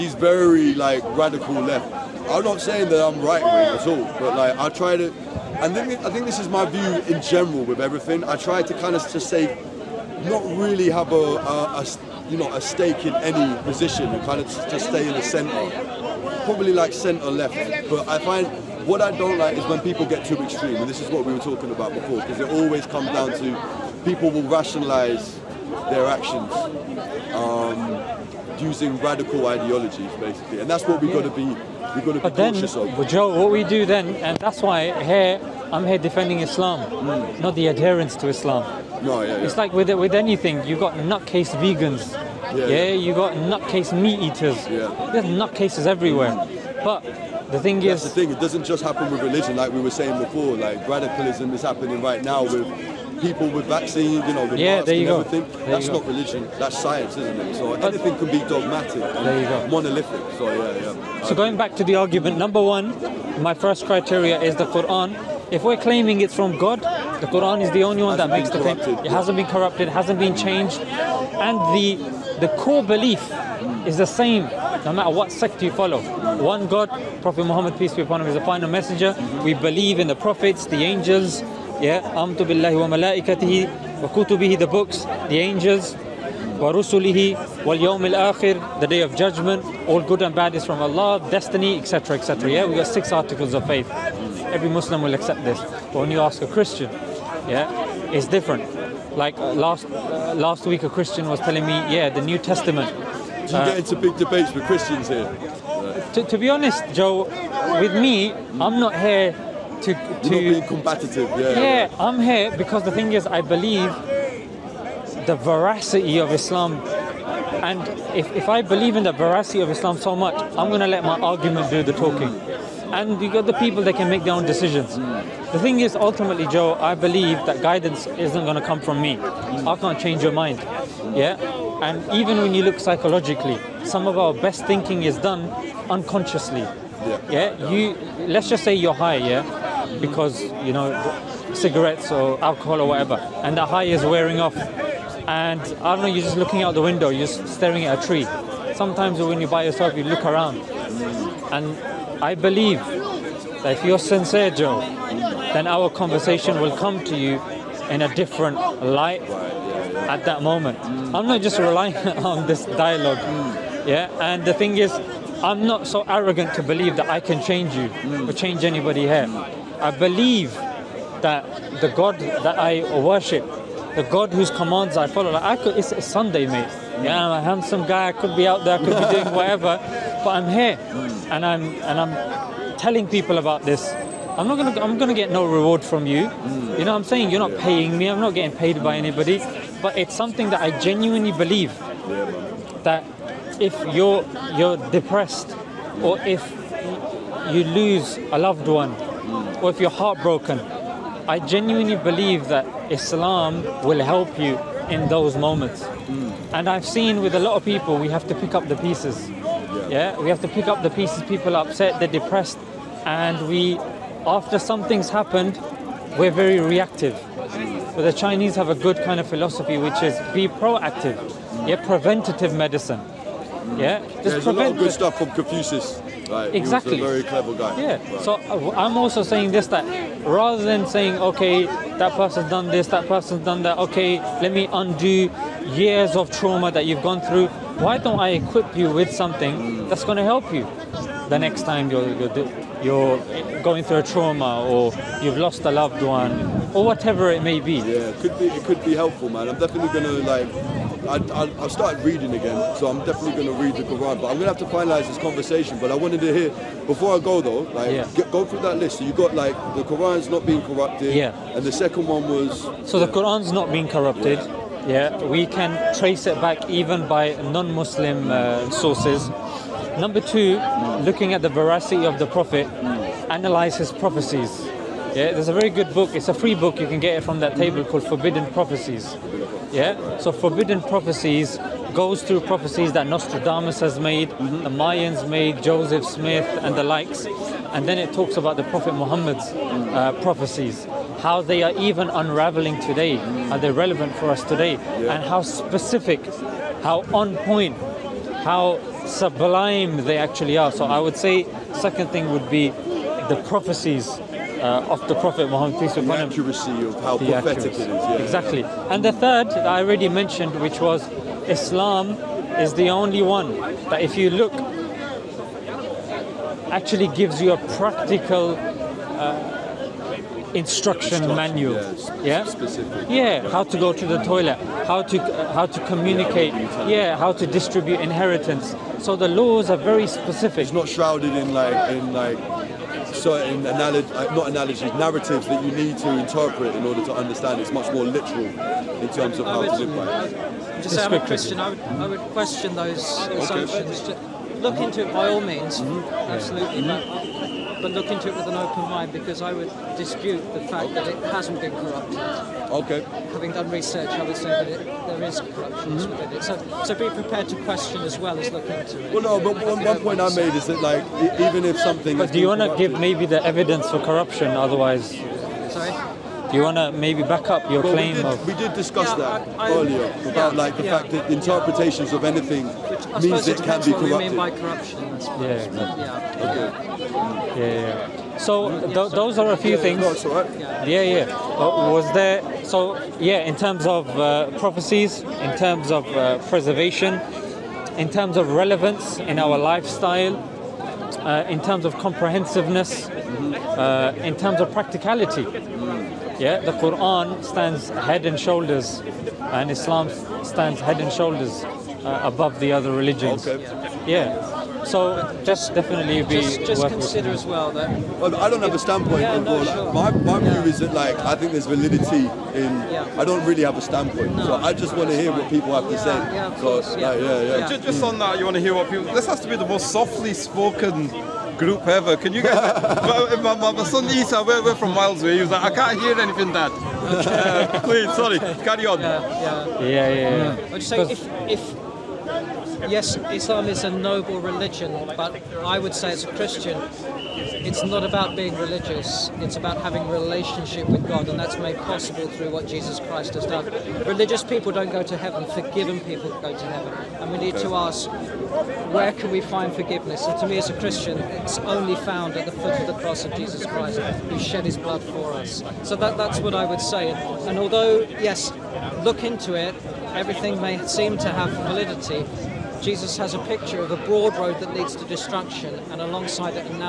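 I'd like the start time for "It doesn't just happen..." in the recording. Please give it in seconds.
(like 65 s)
48 s.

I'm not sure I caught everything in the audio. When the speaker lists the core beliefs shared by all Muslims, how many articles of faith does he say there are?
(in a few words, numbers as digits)
6.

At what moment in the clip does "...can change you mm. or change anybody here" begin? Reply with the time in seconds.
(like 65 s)
167 s.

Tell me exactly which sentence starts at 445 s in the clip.
Forgiven people go to heaven, and we need to ask where can we find forgiveness?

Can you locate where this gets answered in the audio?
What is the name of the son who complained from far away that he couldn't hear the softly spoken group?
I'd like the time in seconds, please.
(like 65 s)
424 s.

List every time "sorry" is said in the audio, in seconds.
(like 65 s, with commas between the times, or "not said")
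365 s, 428 s.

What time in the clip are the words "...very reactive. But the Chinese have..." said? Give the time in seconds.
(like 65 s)
216 s.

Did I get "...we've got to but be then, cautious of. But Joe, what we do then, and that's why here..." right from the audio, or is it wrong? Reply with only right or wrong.
right.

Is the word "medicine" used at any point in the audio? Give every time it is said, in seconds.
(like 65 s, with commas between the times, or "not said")
222 s.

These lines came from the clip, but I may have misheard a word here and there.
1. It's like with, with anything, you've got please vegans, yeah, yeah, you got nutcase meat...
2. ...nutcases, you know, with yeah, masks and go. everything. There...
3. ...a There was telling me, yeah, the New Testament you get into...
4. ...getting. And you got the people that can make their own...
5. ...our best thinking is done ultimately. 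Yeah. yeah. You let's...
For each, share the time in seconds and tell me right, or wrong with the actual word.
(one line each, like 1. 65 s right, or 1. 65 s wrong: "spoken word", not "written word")
1. 39 s wrong: "nutcase", not "please"
2. 53 s wrong: "vaccines", not "nutcases"
3. 100 s wrong: "Christian", not "There"
4. 121 s wrong: "talking", not "getting"
5. 134 s wrong: "unconsciously", not "ultimately".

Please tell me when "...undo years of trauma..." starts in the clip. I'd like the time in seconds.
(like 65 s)
234 s.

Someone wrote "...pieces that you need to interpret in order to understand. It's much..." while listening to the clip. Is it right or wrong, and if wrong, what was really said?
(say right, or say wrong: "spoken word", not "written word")
wrong: "narratives", not "pieces".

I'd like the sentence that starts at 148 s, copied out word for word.
Sometimes when you're by yourself, you look around.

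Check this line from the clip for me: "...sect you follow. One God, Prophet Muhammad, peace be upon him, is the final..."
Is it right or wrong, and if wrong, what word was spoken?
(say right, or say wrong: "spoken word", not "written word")
right.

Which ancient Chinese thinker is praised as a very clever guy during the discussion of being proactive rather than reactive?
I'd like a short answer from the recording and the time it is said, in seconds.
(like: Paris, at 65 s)
Confucius, at 225 s.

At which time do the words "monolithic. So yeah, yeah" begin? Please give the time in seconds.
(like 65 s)
59 s.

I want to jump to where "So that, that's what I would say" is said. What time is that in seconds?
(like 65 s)
455 s.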